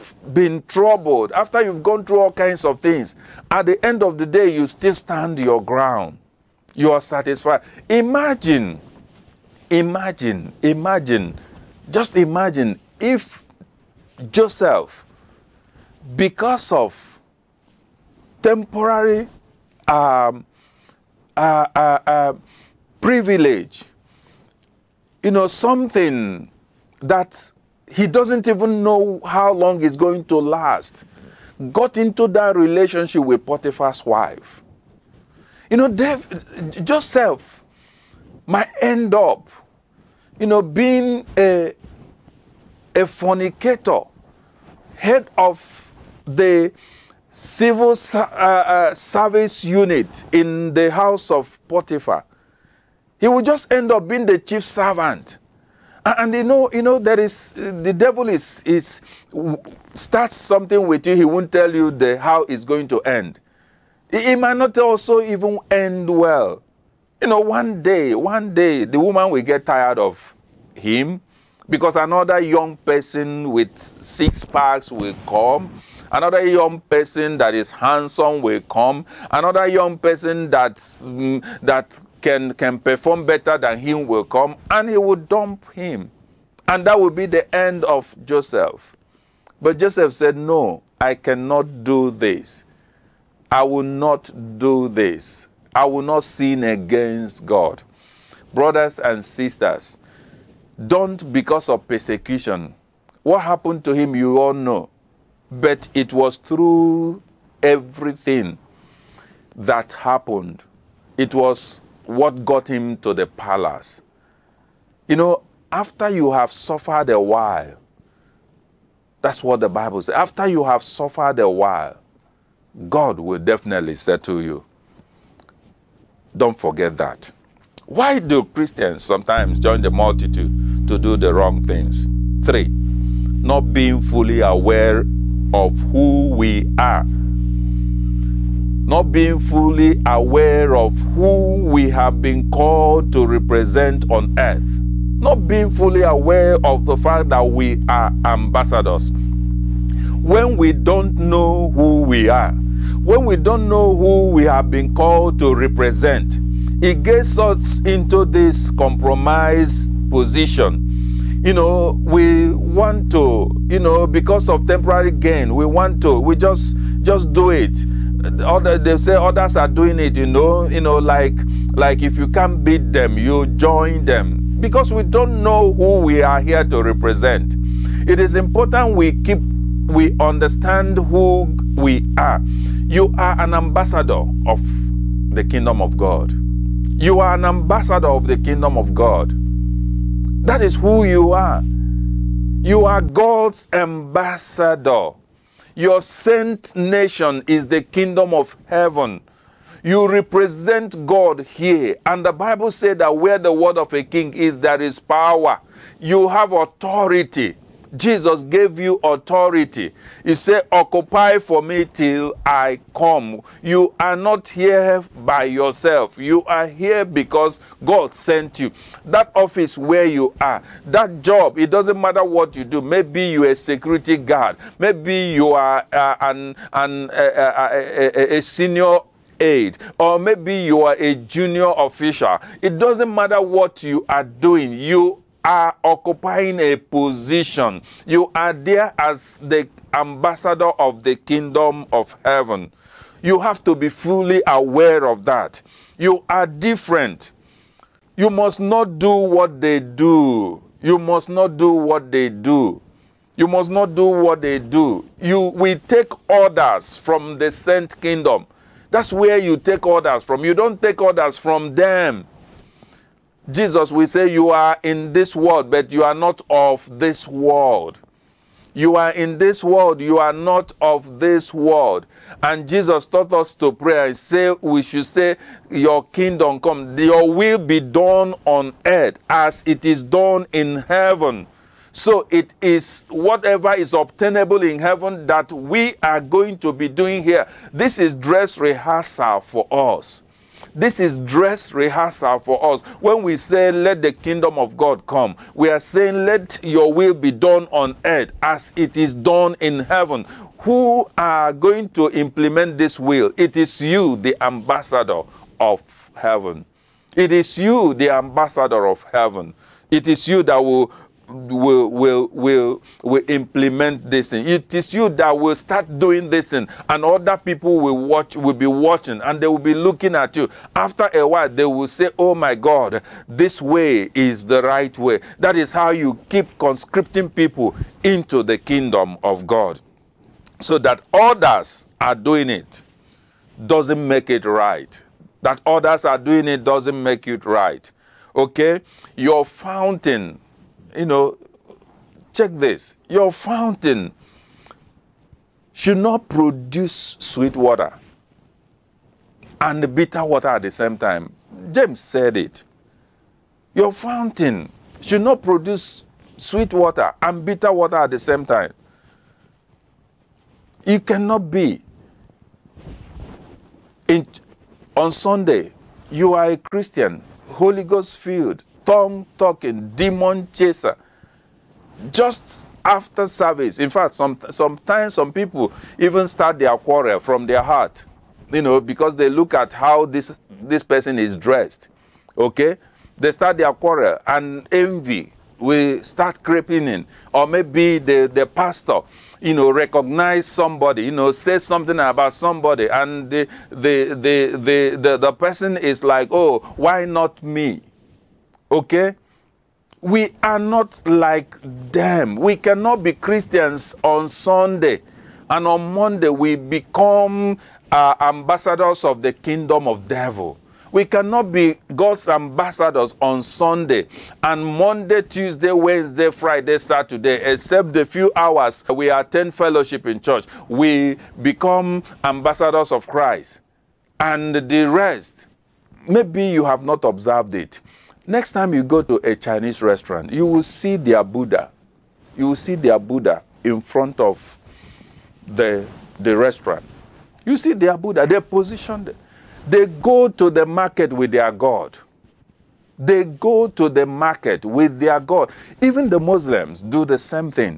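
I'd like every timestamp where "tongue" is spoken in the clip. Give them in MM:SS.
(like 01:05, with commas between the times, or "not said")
06:08.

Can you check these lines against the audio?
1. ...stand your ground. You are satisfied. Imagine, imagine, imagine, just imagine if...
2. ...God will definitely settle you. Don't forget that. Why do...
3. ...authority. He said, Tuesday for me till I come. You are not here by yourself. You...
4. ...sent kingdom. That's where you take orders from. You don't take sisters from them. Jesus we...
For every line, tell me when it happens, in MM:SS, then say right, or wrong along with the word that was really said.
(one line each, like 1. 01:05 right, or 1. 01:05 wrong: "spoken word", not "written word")
1. 00:04 right
2. 02:02 right
3. 03:29 wrong: "Occupy", not "Tuesday"
4. 04:17 wrong: "orders", not "sisters".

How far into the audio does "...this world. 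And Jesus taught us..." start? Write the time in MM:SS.
04:31.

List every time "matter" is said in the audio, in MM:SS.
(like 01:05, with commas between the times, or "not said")
03:41, 03:53.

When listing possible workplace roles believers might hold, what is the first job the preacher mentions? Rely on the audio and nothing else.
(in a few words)
security guard.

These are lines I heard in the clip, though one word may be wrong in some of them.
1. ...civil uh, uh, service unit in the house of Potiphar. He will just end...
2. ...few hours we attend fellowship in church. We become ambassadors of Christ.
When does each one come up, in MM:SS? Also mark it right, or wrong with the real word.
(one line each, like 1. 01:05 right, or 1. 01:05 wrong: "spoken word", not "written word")
1. 00:47 right
2. 06:58 right.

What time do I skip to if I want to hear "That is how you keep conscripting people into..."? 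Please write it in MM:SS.
05:25.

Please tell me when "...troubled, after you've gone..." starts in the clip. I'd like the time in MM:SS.
00:00.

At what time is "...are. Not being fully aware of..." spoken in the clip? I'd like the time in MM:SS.
02:16.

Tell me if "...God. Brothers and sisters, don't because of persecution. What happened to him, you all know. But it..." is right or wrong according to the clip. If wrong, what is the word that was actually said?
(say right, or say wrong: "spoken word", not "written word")
right.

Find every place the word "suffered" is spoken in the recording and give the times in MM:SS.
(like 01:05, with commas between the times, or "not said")
01:56, 02:00.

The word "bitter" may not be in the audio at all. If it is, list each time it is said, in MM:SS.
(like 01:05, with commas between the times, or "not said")
05:49, 05:57.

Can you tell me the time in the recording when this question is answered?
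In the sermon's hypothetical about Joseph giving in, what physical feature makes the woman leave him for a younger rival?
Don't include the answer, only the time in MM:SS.
01:13.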